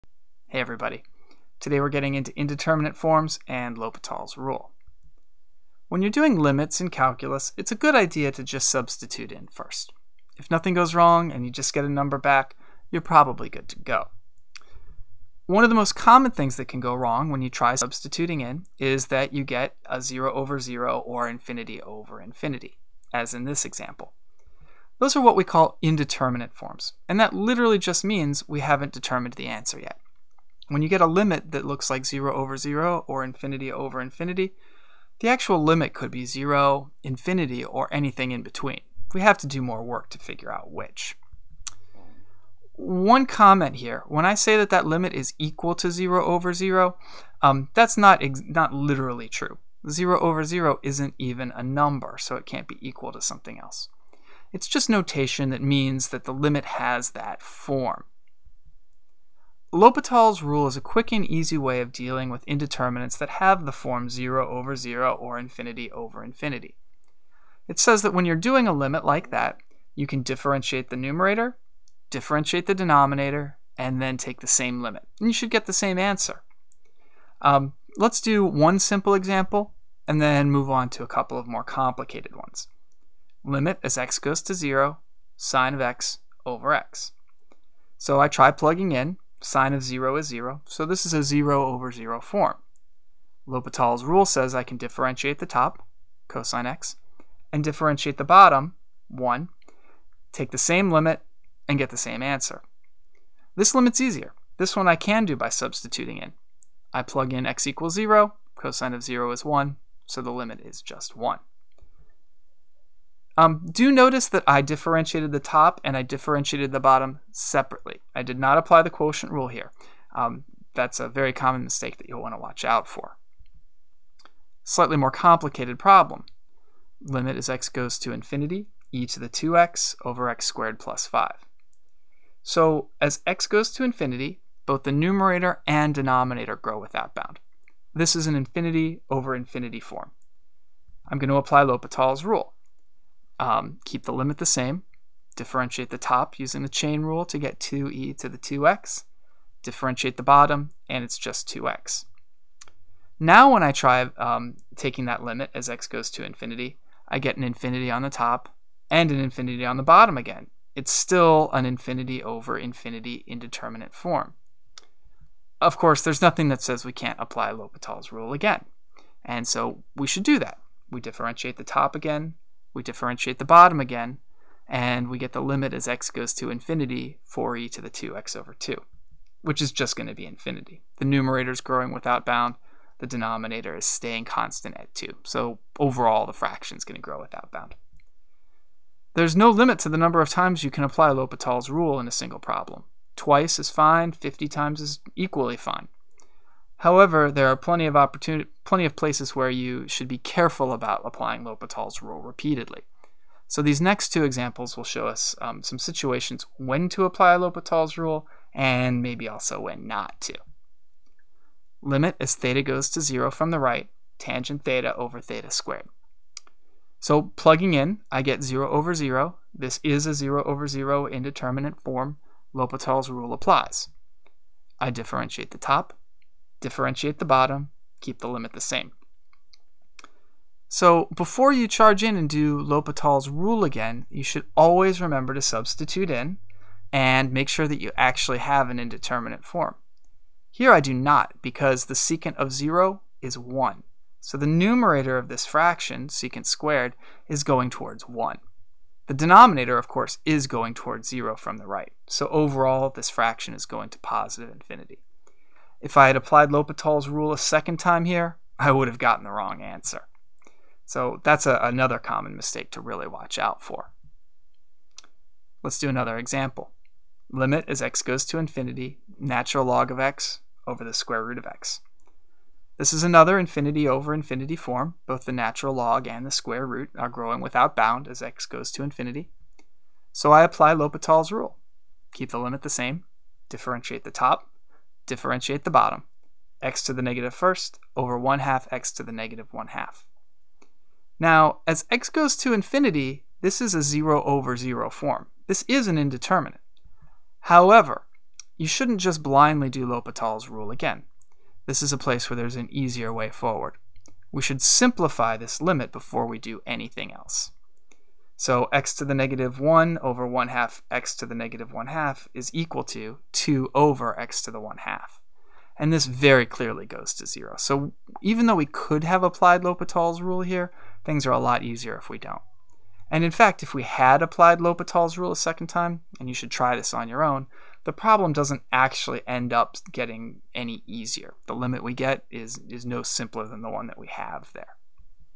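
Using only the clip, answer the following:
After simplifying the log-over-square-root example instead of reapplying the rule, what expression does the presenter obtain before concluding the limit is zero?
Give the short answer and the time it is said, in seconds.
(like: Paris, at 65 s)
2 over x to the 1/2, at 313 s.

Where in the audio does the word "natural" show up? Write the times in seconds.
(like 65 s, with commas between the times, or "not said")
269 s, 275 s.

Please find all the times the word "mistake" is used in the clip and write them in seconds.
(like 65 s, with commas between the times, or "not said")
121 s, 262 s.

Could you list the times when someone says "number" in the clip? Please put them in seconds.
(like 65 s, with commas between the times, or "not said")
11 s, 51 s, 189 s.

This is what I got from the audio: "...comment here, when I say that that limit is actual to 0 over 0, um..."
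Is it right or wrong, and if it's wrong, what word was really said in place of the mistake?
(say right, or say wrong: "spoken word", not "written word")
wrong: "equal", not "actual".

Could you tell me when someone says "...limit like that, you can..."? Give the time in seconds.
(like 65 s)
68 s.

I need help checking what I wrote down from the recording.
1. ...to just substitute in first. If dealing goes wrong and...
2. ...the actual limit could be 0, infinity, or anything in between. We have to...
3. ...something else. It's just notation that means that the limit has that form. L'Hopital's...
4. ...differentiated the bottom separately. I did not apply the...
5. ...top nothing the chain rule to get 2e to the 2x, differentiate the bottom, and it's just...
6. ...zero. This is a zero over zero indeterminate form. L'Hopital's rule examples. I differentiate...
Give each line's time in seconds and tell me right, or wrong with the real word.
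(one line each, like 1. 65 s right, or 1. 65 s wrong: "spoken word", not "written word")
1. 8 s wrong: "nothing", not "dealing"
2. 35 s right
3. 53 s right
4. 116 s right
5. 145 s wrong: "using", not "nothing"
6. 218 s wrong: "applies", not "examples".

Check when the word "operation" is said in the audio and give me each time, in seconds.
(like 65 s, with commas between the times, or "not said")
not said.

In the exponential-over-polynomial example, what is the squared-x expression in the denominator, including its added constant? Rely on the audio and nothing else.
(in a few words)
x squared plus 5.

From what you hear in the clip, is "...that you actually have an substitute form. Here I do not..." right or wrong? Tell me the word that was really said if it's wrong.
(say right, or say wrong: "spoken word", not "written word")
wrong: "indeterminate", not "substitute".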